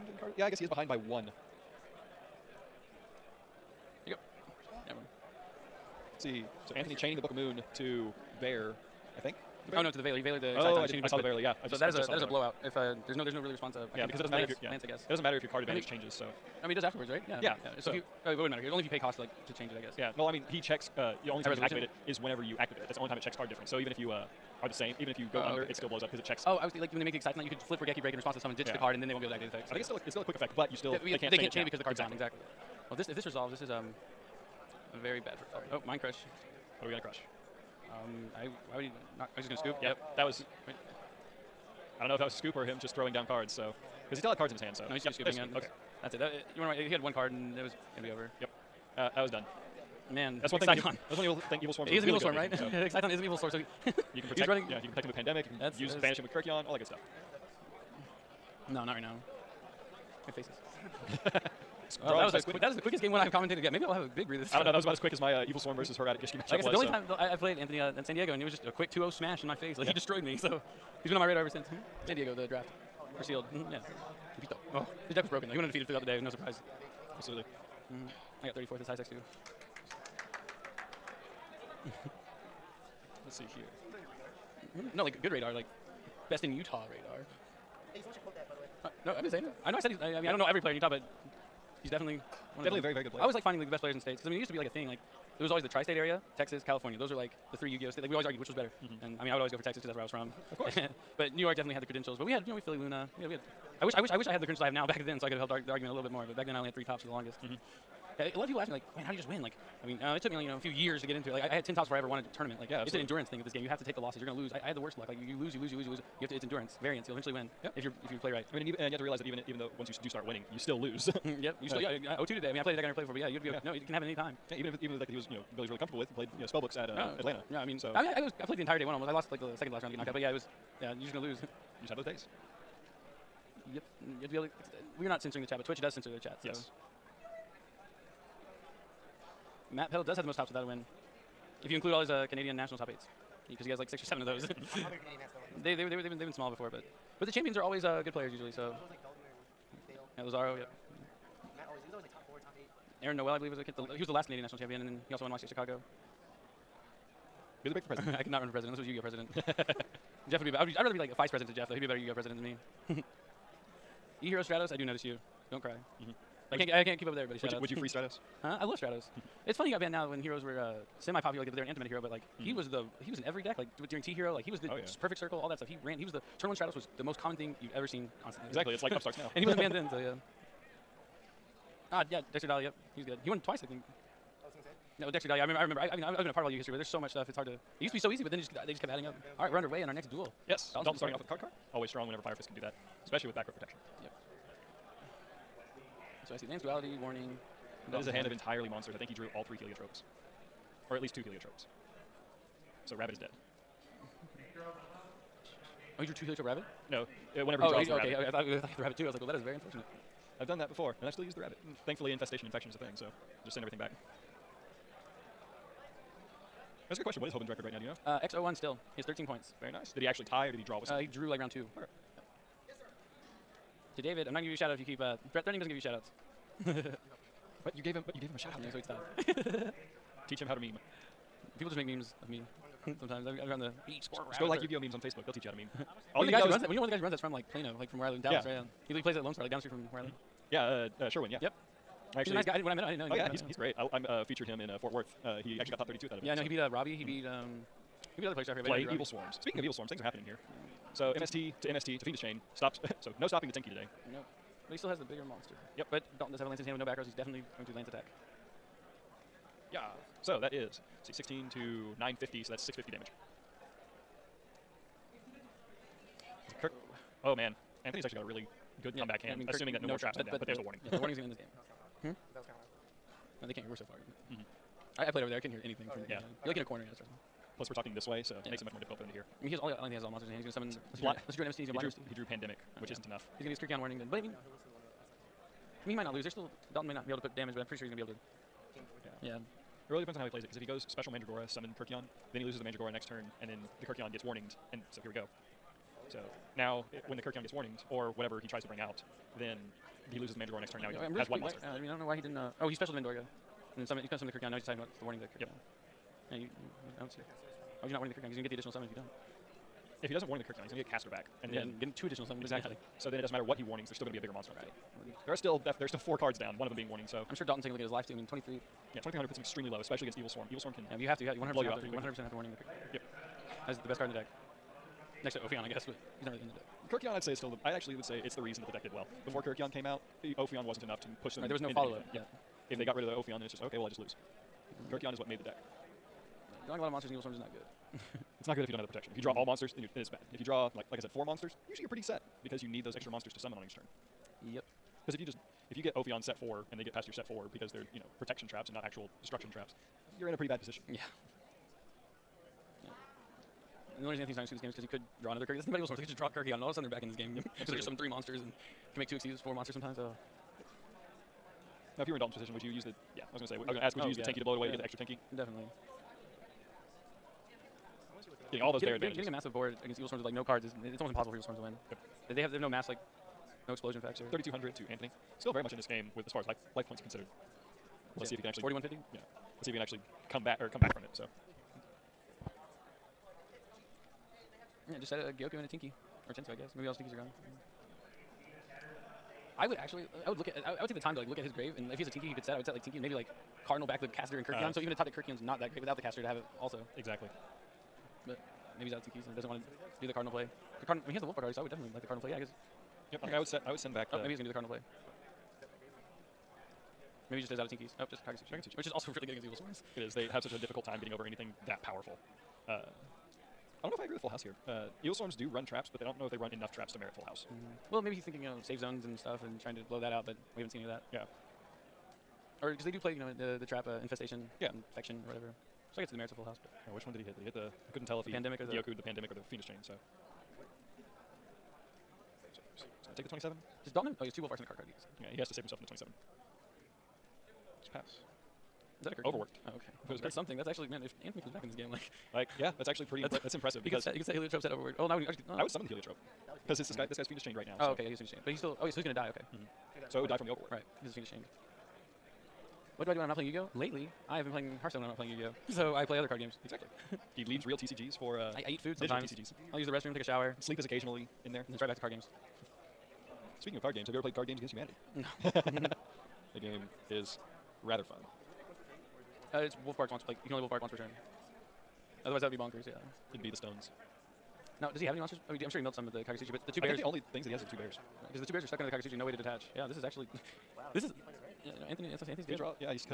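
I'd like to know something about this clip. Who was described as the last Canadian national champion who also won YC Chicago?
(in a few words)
Aaron Noel.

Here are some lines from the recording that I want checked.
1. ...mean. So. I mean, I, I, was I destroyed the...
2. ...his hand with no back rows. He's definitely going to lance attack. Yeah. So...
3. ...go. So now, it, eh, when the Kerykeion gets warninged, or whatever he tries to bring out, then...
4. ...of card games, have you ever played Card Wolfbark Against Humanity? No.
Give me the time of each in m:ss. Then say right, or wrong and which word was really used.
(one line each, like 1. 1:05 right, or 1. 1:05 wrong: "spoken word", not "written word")
1. 2:07 wrong: "played", not "destroyed"
2. 4:16 right
3. 4:55 right
4. 7:43 wrong: "Games", not "Wolfbark".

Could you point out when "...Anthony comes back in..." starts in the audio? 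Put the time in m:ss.
7:21.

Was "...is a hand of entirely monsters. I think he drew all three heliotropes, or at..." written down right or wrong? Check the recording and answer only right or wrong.
right.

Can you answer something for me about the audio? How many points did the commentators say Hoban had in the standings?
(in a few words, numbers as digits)
13.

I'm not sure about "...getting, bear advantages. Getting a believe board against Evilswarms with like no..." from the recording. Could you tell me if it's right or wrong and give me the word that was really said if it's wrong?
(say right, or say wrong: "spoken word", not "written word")
wrong: "massive", not "believe".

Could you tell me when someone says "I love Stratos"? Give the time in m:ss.
2:48.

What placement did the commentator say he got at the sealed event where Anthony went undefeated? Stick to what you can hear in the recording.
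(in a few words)
34th.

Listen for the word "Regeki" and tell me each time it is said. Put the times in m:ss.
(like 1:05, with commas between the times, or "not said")
0:27.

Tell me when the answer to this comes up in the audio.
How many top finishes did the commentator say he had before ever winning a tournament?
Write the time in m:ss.
1:51.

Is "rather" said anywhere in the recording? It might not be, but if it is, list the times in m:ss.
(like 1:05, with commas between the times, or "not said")
2:40, 7:47.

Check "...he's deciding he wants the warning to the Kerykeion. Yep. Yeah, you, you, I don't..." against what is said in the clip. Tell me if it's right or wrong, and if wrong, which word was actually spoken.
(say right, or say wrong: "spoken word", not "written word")
right.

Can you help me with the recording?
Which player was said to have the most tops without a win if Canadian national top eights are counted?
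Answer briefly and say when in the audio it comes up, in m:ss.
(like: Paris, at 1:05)
Matt Peddle, at 2:19.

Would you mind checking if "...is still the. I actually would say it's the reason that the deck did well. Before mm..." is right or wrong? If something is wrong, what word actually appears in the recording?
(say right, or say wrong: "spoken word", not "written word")
right.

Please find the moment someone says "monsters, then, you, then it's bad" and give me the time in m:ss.
5:39.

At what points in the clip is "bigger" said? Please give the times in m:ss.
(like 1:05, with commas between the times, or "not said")
4:15, 5:14.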